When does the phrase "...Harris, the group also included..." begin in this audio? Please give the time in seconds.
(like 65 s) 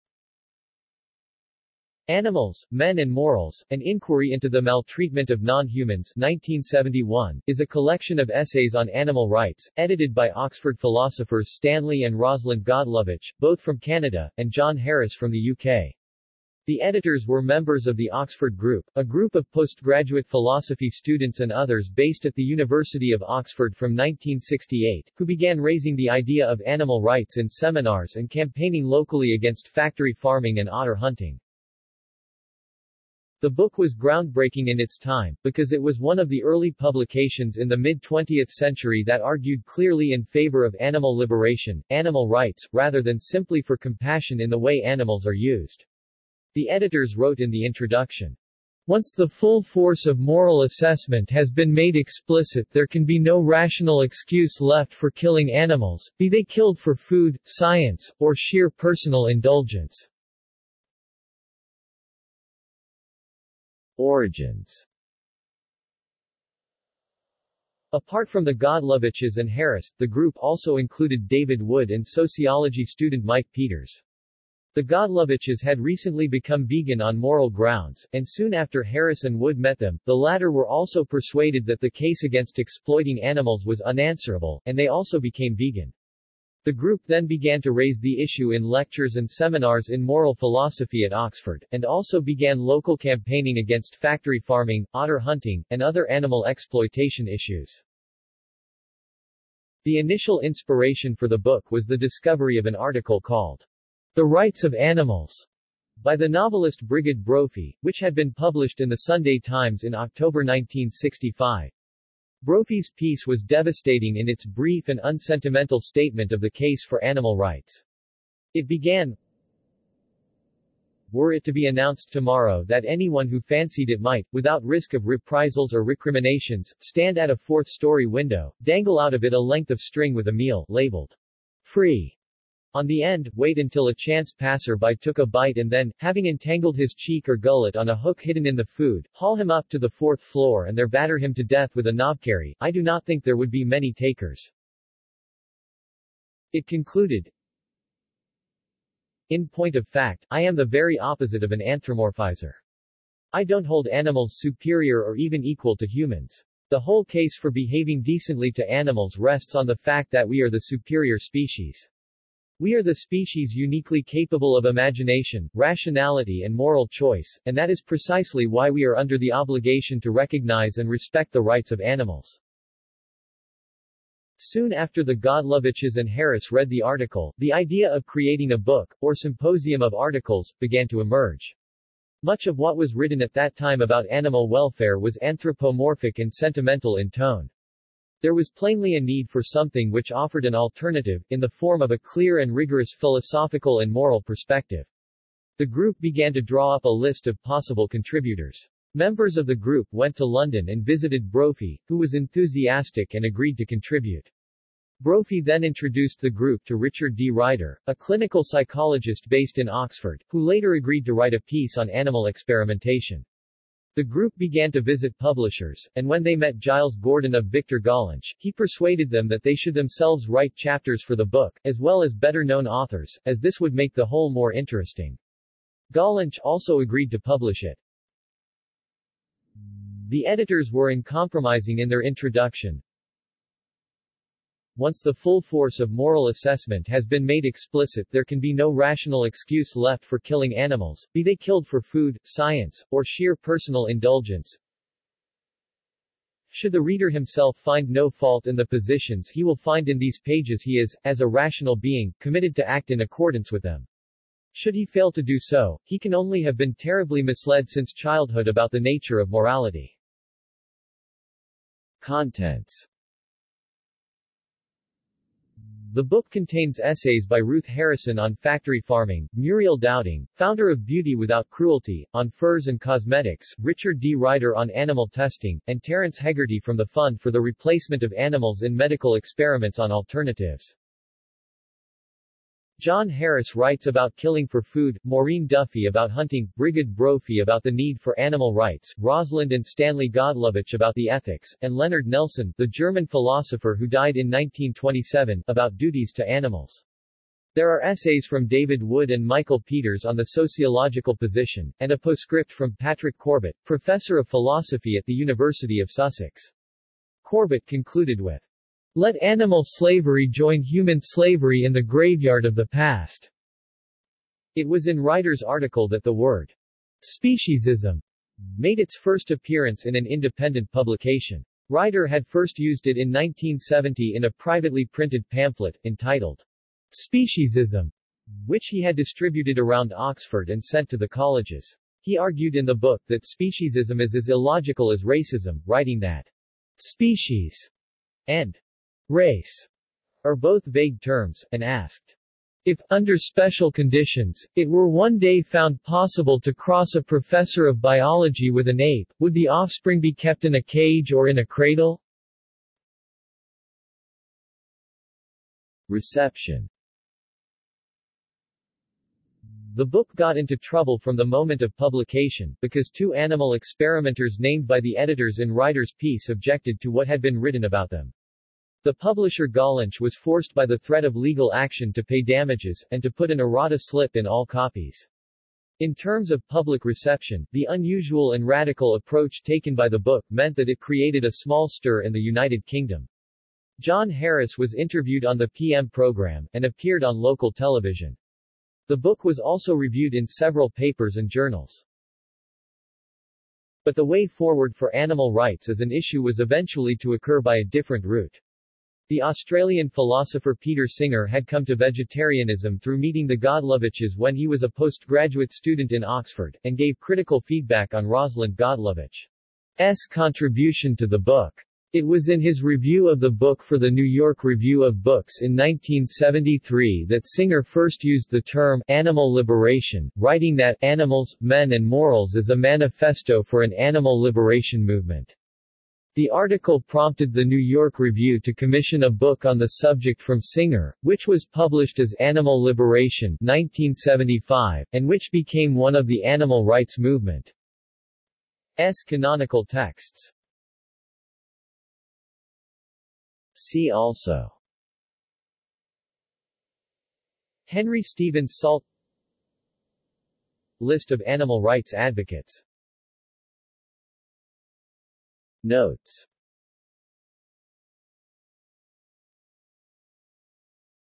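69 s.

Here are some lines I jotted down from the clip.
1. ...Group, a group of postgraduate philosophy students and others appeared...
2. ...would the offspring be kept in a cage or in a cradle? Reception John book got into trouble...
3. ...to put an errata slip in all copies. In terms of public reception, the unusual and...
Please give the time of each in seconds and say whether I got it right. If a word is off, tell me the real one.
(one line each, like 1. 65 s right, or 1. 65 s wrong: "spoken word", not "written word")
1. 18 s wrong: "based", not "appeared"
2. 349 s wrong: "The", not "John"
3. 373 s right.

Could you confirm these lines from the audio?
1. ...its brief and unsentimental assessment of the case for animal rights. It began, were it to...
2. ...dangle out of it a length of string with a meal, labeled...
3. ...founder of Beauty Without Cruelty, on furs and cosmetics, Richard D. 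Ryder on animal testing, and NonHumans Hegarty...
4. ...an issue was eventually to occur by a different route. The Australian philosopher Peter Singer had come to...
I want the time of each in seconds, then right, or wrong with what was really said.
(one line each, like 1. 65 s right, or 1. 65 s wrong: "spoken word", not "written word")
1. 114 s wrong: "statement", not "assessment"
2. 128 s right
3. 270 s wrong: "Terence", not "NonHumans"
4. 395 s right.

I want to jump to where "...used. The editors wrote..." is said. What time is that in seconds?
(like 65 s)
45 s.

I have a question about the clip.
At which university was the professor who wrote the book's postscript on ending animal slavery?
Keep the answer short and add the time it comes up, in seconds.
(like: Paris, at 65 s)
University of Sussex, at 305 s.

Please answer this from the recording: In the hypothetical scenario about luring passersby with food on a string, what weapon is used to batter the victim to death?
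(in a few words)
knobkerry.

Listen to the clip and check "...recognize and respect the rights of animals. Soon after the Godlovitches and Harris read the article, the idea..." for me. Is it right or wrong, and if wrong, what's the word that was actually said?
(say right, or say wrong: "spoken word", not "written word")
right.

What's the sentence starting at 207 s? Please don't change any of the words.
Ryder, a clinical psychologist based in Oxford, who later agreed to write a piece on animal experimentation.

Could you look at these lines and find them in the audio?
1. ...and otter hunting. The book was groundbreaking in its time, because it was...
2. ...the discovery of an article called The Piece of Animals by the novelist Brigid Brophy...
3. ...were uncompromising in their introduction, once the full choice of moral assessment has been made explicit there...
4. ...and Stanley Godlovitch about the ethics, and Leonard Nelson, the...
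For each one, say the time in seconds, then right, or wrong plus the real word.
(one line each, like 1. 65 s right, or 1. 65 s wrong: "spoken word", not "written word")
1. 30 s right
2. 101 s wrong: "Rights", not "Piece"
3. 230 s wrong: "force", not "choice"
4. 289 s right.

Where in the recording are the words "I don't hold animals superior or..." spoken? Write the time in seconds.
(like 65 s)
153 s.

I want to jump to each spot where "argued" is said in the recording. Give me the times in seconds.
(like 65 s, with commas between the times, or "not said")
39 s, 332 s.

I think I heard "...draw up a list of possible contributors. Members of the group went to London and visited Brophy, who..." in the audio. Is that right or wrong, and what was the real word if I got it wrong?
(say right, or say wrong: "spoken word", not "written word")
right.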